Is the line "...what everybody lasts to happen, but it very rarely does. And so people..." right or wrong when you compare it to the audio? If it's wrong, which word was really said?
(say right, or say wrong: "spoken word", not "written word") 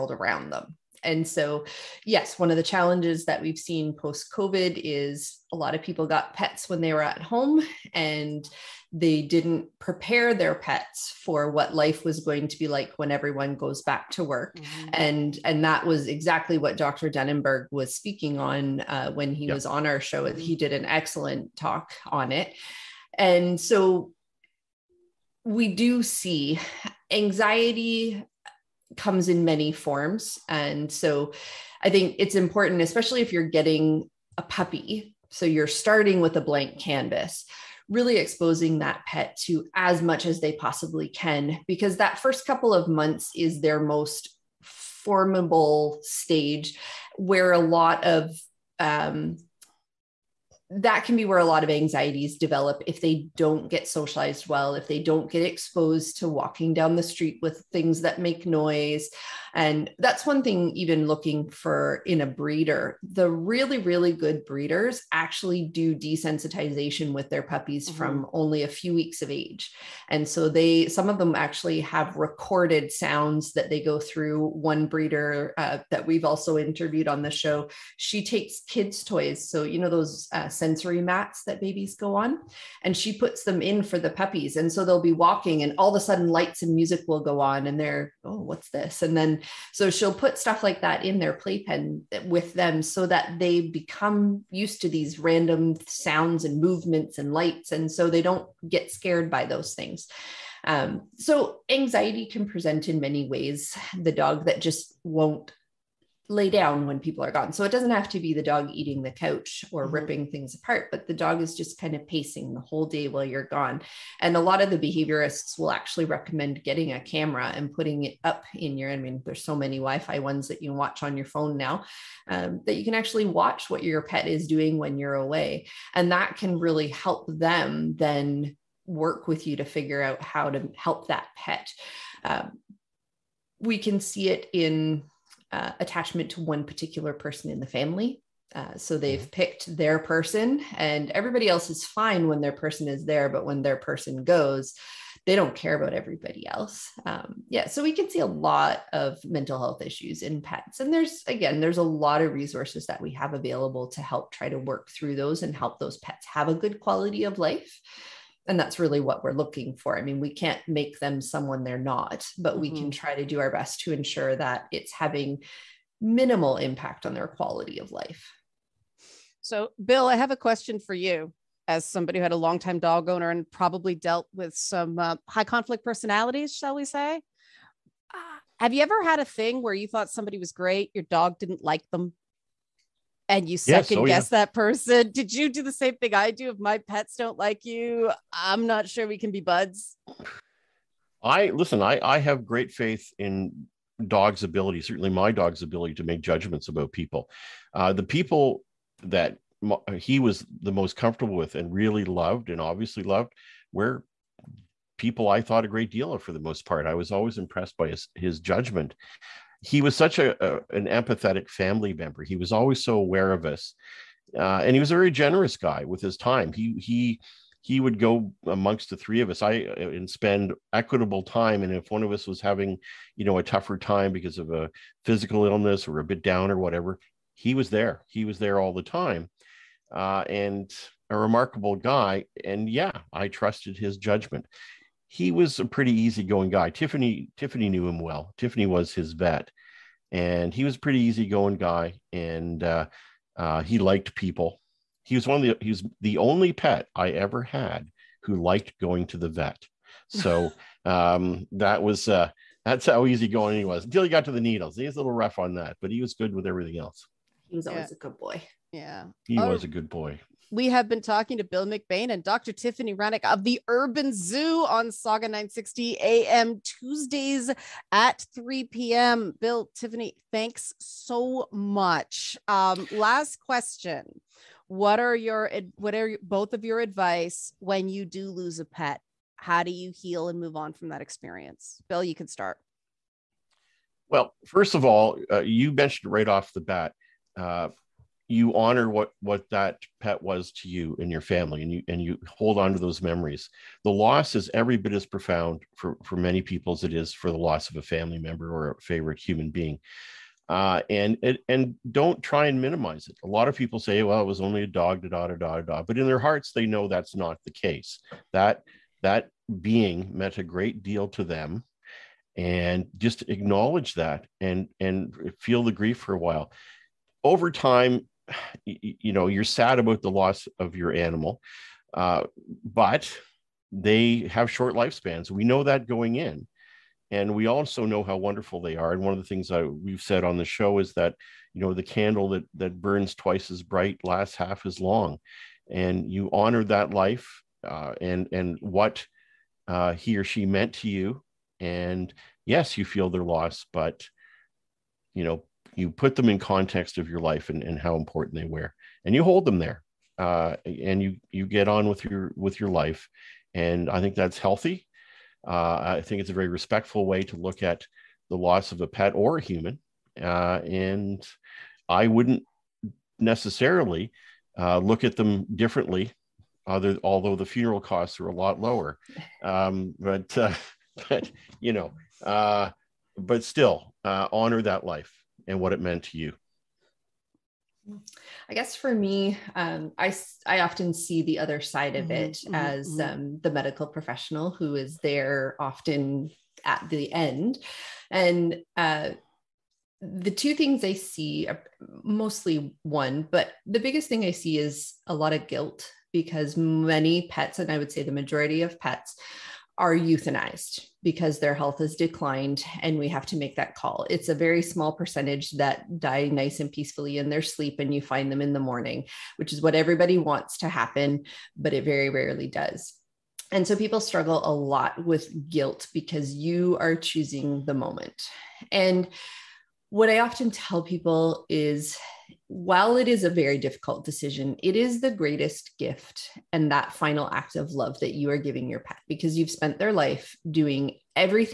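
wrong: "wants", not "lasts".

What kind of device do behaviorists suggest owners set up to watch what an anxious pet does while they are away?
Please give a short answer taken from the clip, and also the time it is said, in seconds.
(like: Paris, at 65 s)
A camera, at 116 s.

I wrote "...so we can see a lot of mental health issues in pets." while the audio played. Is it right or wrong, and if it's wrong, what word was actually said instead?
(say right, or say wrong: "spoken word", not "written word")
right.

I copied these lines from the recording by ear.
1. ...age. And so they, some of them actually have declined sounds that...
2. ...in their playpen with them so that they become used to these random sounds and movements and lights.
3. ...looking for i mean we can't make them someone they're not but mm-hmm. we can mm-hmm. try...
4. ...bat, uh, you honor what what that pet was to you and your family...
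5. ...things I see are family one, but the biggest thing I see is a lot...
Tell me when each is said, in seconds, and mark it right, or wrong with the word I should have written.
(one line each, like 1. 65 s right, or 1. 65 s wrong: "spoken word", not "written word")
1. 69 s wrong: "recorded", not "declined"
2. 91 s right
3. 159 s right
4. 286 s right
5. 390 s wrong: "mostly", not "family".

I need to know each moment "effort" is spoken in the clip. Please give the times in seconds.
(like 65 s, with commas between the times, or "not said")
not said.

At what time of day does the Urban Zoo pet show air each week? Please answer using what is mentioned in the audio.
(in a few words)
3 p.m.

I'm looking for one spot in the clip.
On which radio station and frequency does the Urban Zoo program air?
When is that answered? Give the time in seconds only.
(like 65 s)
264 s.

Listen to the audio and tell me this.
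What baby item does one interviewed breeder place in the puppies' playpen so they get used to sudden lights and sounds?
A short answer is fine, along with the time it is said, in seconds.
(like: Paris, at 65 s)
Sensory mats, at 80 s.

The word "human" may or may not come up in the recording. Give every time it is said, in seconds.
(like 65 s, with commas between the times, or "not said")
299 s, 359 s.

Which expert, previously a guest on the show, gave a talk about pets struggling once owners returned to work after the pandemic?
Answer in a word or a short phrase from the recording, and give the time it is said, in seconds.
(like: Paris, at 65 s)
Dr. Denenberg, at 16 s.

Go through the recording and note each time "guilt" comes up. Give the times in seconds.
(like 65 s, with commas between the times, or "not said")
395 s, 415 s.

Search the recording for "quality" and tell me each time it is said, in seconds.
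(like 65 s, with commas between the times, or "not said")
156 s, 167 s.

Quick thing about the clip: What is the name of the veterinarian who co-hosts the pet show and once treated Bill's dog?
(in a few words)
Tiffany Rennick.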